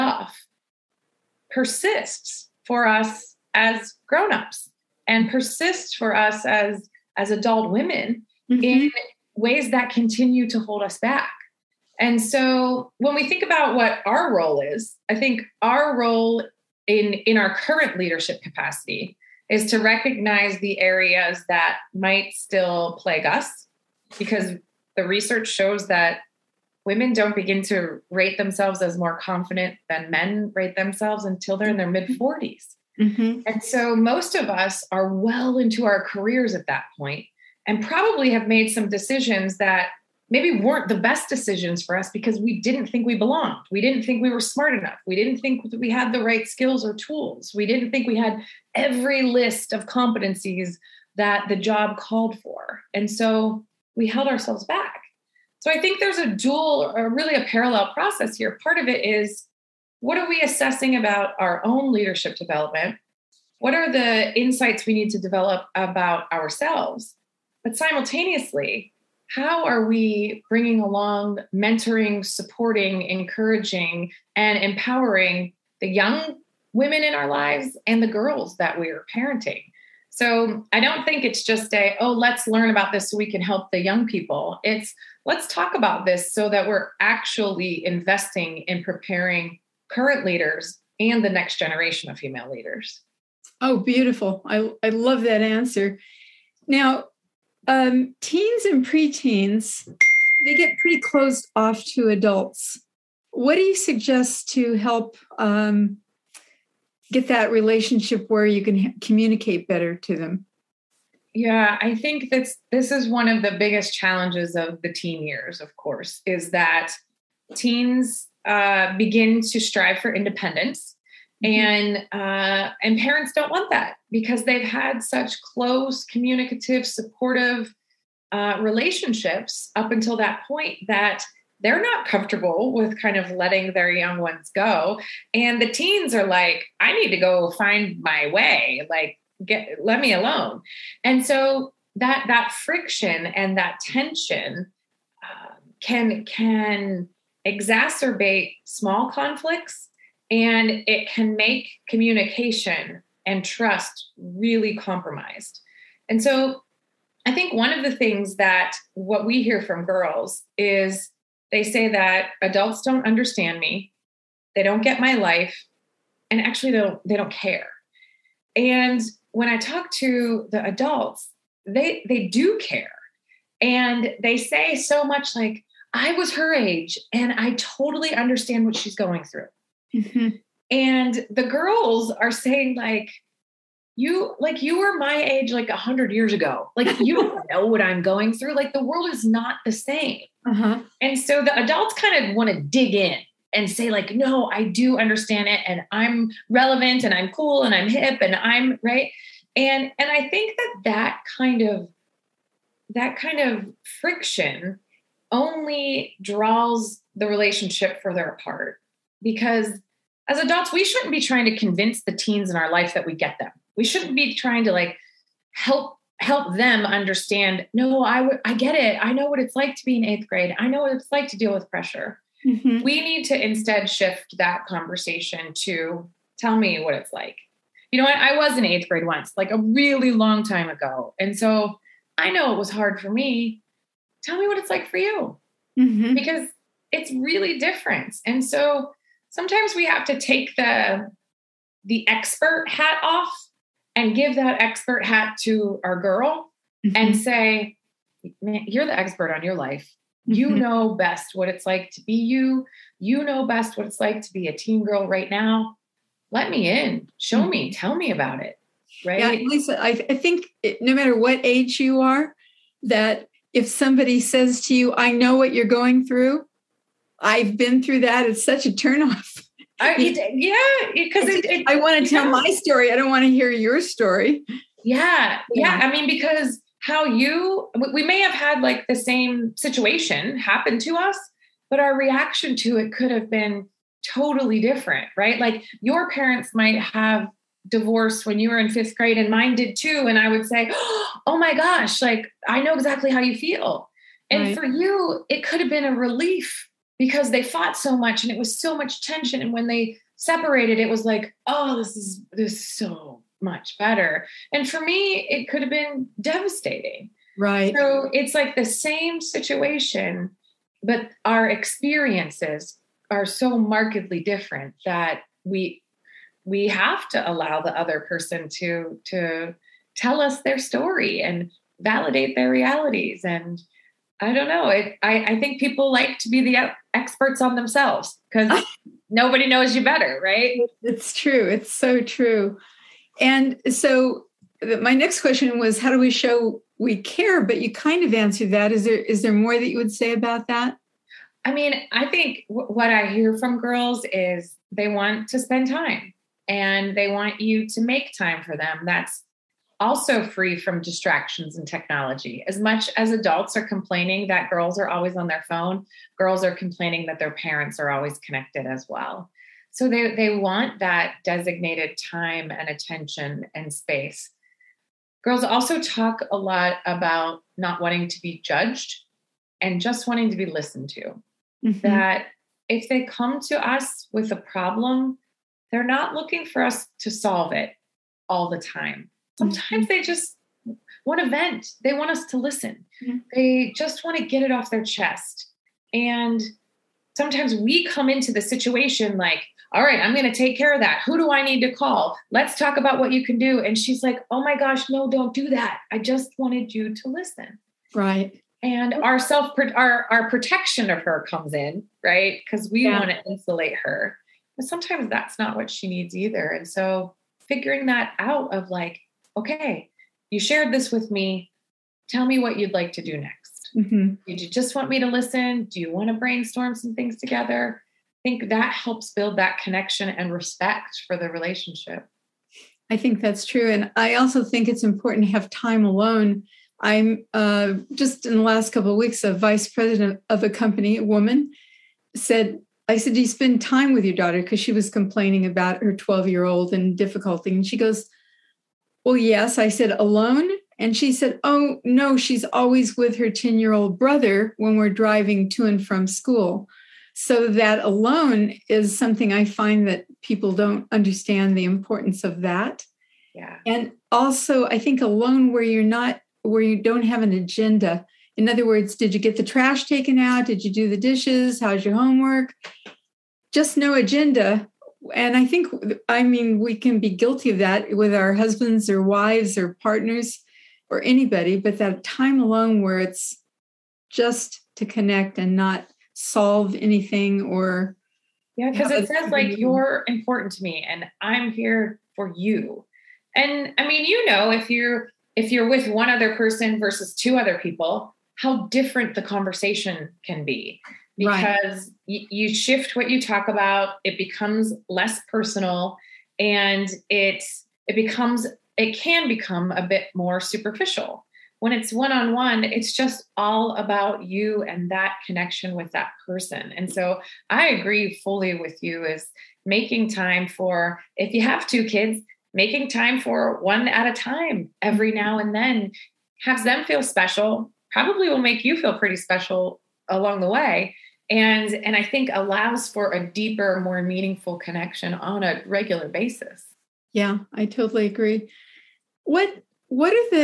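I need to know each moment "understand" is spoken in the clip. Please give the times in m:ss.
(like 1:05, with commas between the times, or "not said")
2:43, 2:58, 3:14, 3:36, 7:30.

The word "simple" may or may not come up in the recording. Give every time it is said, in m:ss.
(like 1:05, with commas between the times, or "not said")
not said.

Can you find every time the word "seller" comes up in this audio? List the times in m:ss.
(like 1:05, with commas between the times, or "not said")
not said.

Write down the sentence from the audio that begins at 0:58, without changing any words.
Part of it is what are we assessing about our own leadership development?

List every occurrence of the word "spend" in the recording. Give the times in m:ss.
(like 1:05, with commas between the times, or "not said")
5:45, 7:13.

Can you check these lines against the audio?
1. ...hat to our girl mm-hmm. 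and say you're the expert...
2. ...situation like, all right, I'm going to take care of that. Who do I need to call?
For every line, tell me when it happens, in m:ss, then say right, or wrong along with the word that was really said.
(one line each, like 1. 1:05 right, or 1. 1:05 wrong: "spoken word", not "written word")
1. 4:05 right
2. 6:28 right.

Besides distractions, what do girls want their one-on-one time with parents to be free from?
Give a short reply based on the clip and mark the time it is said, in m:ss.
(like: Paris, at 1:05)
technology, at 5:51.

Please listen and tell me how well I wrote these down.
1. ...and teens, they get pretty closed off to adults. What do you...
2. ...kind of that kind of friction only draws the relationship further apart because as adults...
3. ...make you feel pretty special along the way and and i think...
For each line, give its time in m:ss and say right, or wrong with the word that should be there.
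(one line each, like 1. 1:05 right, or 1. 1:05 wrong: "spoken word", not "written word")
1. 1:38 wrong: "preteens", not "teens"
2. 3:21 right
3. 8:38 right.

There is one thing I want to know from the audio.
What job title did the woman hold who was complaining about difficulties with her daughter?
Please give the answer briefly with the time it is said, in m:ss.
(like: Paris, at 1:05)
vice president, at 7:09.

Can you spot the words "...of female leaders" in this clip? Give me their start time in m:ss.
1:32.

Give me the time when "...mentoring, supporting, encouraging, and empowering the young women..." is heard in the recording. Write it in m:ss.
1:11.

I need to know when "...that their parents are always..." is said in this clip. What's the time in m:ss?
5:57.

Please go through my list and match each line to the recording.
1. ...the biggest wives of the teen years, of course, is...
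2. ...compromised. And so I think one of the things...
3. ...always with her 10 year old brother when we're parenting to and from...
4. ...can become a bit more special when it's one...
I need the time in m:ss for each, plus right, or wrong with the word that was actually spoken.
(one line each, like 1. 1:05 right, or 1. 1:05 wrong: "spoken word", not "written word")
1. 1:53 wrong: "challenges", not "wives"
2. 2:34 right
3. 7:22 wrong: "driving", not "parenting"
4. 8:18 wrong: "superficial", not "special".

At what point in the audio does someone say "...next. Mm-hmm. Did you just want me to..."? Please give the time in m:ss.
6:53.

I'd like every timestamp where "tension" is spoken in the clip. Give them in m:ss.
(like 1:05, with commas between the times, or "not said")
2:23, 4:59.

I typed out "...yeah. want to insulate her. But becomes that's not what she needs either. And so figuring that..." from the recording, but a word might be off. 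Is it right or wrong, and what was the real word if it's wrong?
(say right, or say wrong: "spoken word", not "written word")
wrong: "sometimes", not "becomes".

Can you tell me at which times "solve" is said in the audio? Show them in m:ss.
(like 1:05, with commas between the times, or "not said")
6:17, 7:56.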